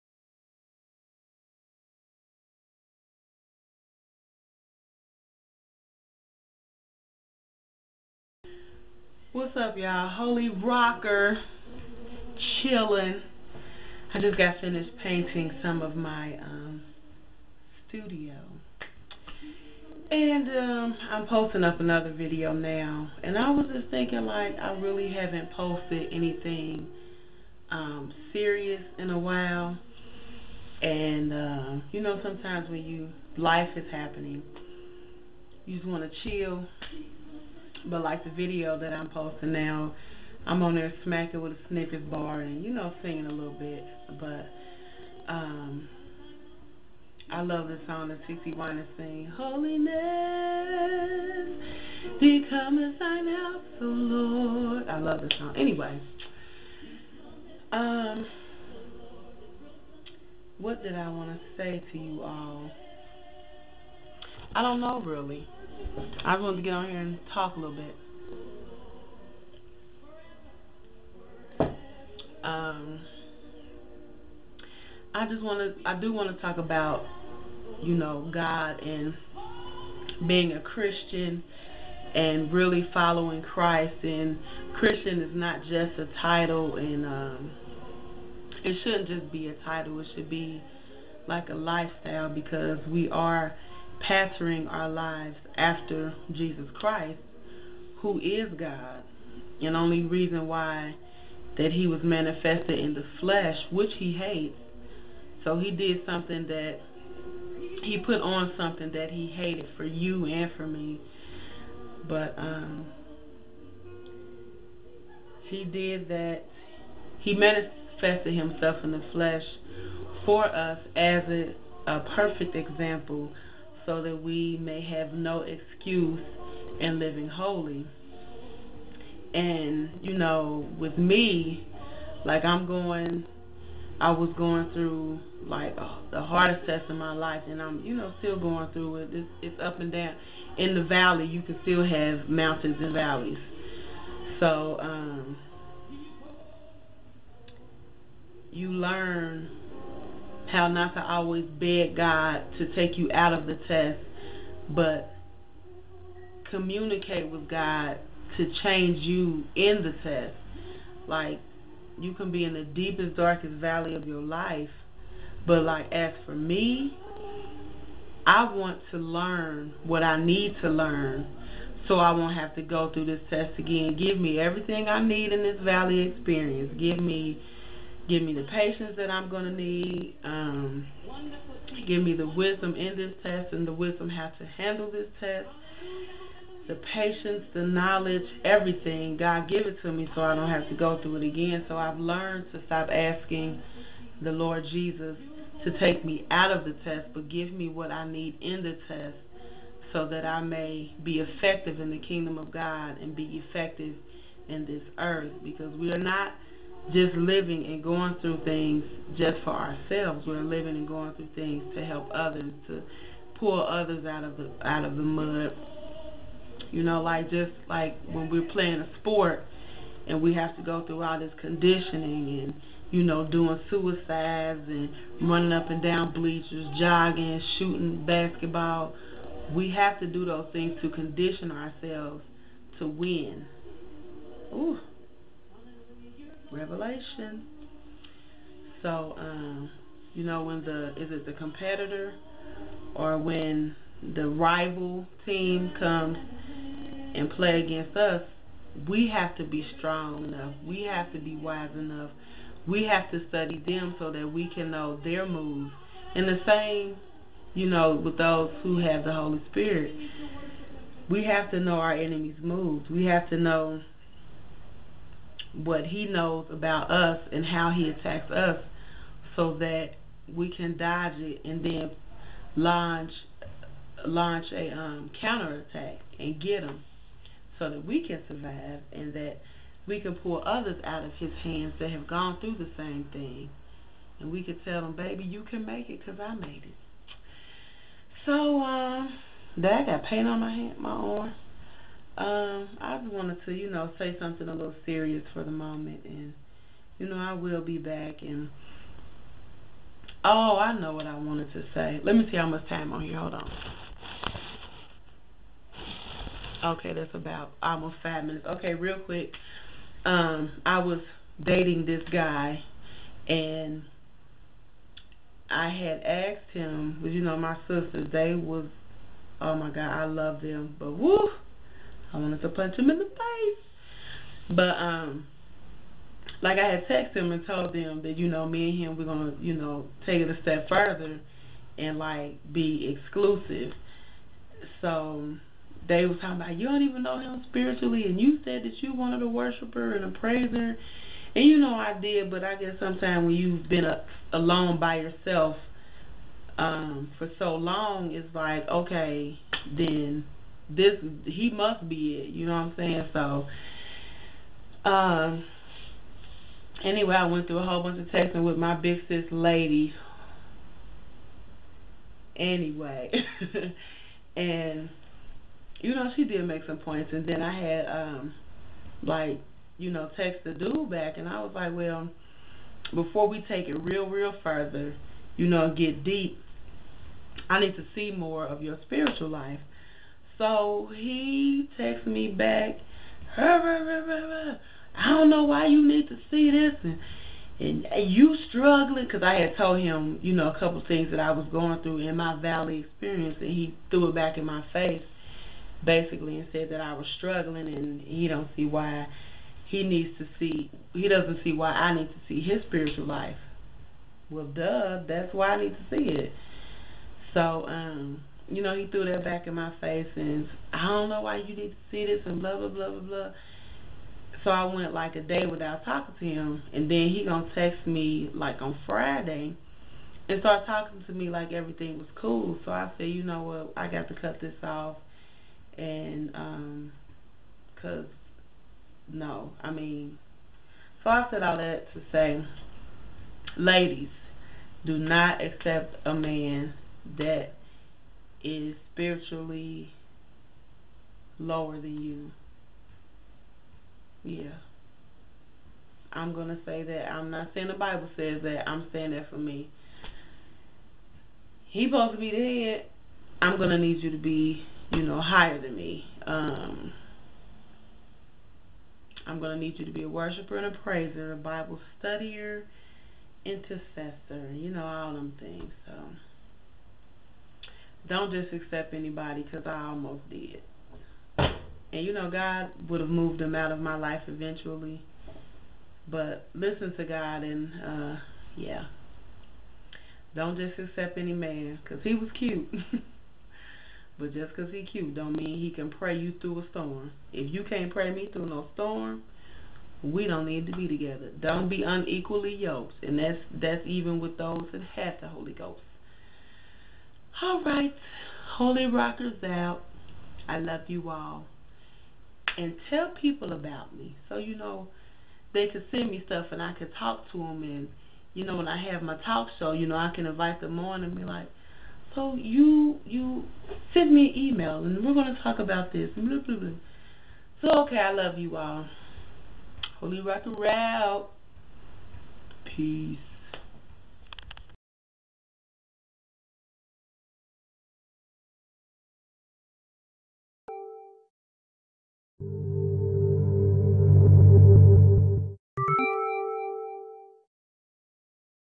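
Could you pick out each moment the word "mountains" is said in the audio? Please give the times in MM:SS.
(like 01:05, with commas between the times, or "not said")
02:22.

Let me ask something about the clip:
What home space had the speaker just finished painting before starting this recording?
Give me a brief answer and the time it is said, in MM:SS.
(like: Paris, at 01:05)
studio, at 00:17.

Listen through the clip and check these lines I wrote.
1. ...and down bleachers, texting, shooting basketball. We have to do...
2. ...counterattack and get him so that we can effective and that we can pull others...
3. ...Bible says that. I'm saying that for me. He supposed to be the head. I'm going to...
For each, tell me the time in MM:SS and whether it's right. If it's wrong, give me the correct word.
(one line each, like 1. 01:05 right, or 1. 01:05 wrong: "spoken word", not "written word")
1. 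03:45 wrong: "jogging", not "texting"
2. 04:35 wrong: "survive", not "effective"
3. 07:27 right.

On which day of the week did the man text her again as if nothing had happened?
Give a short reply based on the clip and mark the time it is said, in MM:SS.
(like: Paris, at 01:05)
Friday, at 06:58.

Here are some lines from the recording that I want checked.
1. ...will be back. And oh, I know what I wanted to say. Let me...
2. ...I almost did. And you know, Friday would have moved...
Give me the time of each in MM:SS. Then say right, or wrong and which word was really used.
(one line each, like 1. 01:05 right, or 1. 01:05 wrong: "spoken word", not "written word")
1. 04:57 right
2. 07:49 wrong: "God", not "Friday".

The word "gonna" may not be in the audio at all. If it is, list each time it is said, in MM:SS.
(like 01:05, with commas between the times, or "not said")
05:29, 06:57.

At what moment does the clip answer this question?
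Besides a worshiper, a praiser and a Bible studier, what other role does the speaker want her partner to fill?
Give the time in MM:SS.
07:43.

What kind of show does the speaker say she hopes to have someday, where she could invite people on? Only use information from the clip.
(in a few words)
talk show.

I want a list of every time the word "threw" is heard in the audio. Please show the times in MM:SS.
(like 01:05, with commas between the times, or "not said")
06:33, 06:48.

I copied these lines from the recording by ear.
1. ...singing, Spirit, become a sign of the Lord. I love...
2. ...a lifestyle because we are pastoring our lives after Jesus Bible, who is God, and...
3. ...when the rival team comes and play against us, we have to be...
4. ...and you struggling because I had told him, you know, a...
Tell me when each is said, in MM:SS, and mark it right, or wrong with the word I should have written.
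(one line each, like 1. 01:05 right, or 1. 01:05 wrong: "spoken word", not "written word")
1. 00:48 wrong: "Holiness", not "Spirit"
2. 01:31 wrong: "Christ", not "Bible"
3. 04:03 right
4. 06:27 right.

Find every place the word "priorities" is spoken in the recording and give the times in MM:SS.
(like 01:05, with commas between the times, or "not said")
not said.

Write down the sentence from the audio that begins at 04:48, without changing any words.
So, um, uh, that I got paint on my hand, my arm.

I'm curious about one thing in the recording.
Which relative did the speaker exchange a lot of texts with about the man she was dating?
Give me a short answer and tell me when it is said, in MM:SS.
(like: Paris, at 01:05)
big sis, at 05:58.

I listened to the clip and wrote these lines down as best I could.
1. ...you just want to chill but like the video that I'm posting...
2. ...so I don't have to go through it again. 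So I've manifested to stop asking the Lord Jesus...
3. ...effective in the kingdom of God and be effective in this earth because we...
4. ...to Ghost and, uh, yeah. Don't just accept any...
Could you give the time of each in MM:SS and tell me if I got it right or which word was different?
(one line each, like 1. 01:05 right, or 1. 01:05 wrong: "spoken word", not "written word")
1. 00:35 right
2. 03:10 wrong: "learned", not "manifested"
3. 03:21 right
4. 07:56 wrong: "God", not "Ghost".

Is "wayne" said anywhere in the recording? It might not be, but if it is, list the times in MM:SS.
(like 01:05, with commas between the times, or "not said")
not said.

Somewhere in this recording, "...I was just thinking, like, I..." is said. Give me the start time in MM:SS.
00:23.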